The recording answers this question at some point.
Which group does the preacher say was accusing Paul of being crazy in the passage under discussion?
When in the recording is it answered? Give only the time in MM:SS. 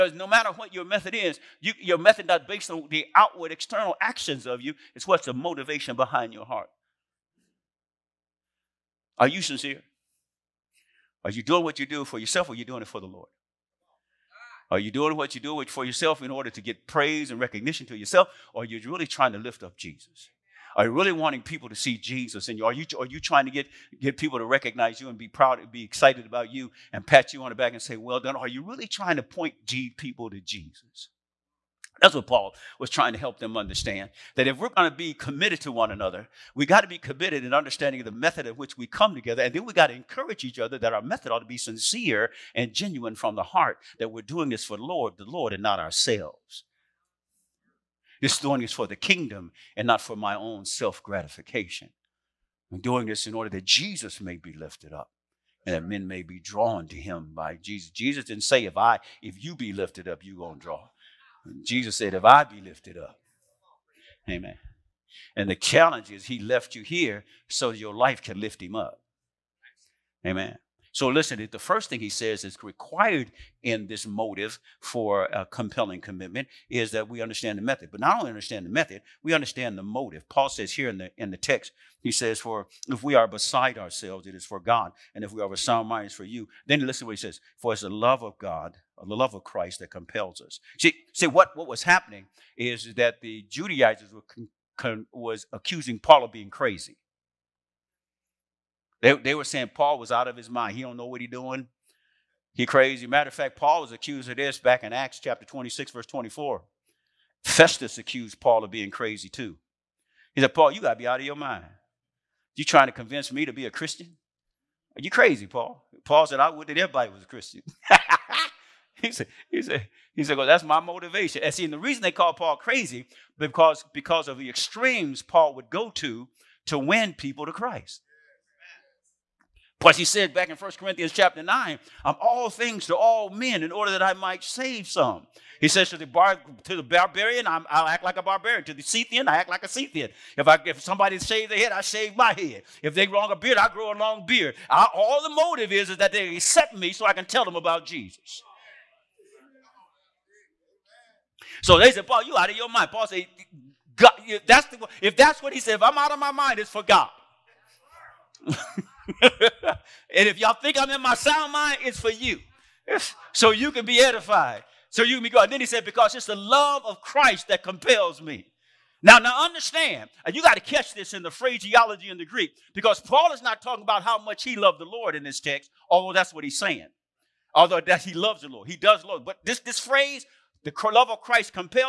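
01:33.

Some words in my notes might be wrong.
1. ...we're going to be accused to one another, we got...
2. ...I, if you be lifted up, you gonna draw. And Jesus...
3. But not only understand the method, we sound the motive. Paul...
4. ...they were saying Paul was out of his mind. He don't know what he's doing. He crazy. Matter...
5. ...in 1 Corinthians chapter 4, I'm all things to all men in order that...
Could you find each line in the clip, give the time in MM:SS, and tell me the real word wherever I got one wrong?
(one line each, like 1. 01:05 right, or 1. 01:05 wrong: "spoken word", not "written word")
1. 00:34 wrong: "committed", not "accused"
2. 00:58 right
3. 01:17 wrong: "understand", not "sound"
4. 01:39 right
5. 02:10 wrong: "9", not "4".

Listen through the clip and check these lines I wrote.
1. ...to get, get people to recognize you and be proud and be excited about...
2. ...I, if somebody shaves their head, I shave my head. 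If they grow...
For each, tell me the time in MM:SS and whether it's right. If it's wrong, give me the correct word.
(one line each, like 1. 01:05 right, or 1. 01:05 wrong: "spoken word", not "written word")
1. 00:23 right
2. 02:20 right.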